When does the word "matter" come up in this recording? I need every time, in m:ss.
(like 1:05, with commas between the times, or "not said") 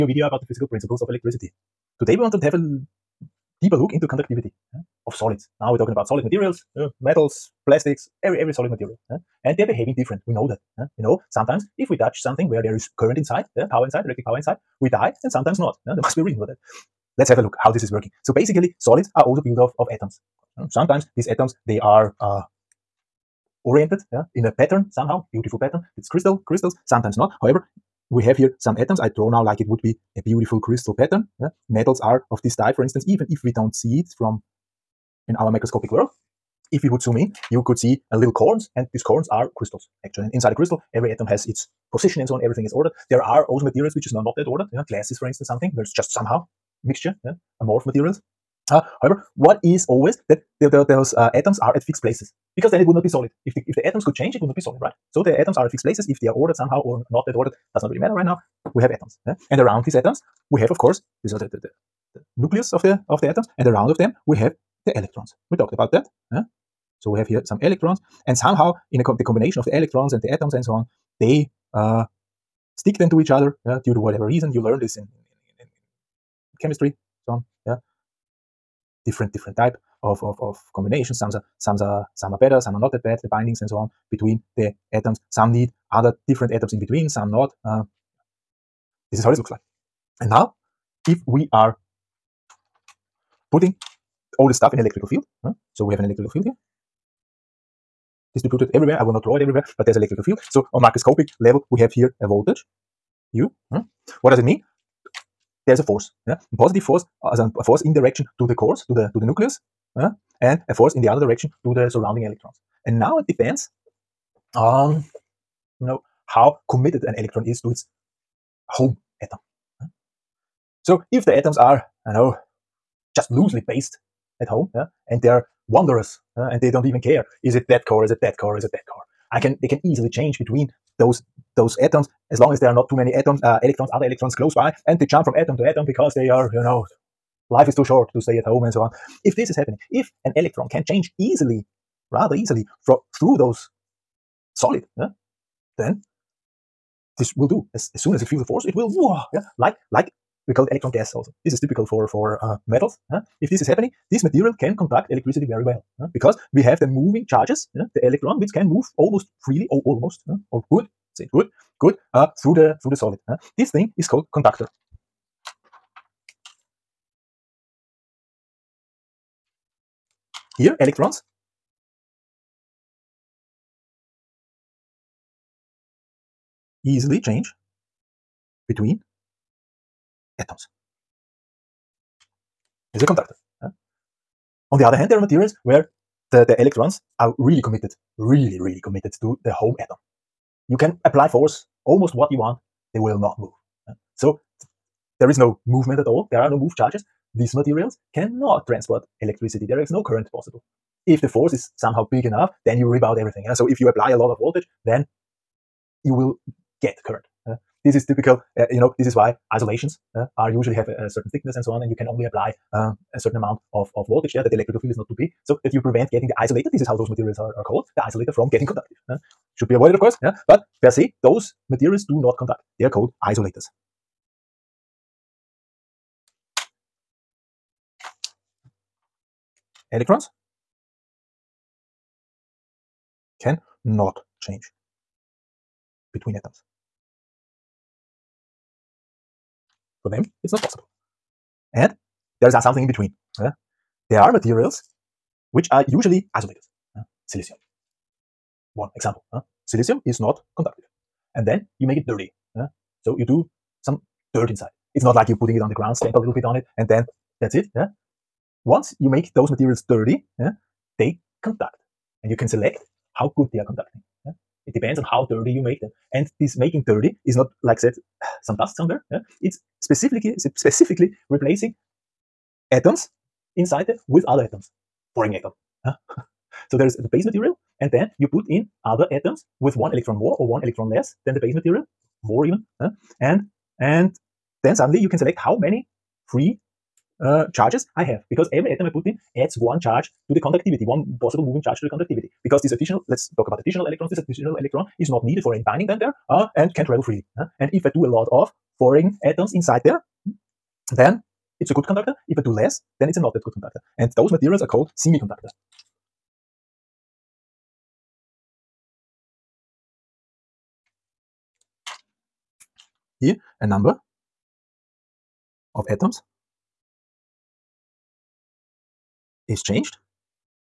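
0:57.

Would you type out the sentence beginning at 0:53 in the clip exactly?
If the if the atoms could change, it would not be solid, right?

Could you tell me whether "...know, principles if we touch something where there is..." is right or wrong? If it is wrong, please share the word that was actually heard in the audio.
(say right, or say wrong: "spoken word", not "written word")
wrong: "sometimes", not "principles".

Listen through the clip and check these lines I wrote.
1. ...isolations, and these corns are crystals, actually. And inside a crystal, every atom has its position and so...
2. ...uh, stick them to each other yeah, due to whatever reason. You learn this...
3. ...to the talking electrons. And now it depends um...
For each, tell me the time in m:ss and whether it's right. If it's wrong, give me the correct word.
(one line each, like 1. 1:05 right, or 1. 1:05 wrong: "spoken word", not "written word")
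1. 0:38 wrong: "corns", not "isolations"
2. 1:11 right
3. 1:51 wrong: "surrounding", not "talking".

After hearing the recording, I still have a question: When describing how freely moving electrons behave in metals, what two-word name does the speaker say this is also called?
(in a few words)
electron gas.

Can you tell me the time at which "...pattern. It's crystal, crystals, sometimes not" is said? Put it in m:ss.
0:25.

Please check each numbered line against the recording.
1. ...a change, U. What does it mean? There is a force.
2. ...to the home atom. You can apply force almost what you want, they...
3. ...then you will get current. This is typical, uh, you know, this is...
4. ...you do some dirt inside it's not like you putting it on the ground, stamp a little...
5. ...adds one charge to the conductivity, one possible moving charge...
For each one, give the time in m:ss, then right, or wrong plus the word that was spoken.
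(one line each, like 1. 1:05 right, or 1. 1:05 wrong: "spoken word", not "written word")
1. 1:42 wrong: "voltage", not "change"
2. 3:09 right
3. 3:24 right
4. 4:13 right
5. 4:49 right.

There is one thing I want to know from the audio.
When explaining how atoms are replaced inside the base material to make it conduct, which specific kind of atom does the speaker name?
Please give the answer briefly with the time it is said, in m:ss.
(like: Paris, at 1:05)
Boron, at 4:35.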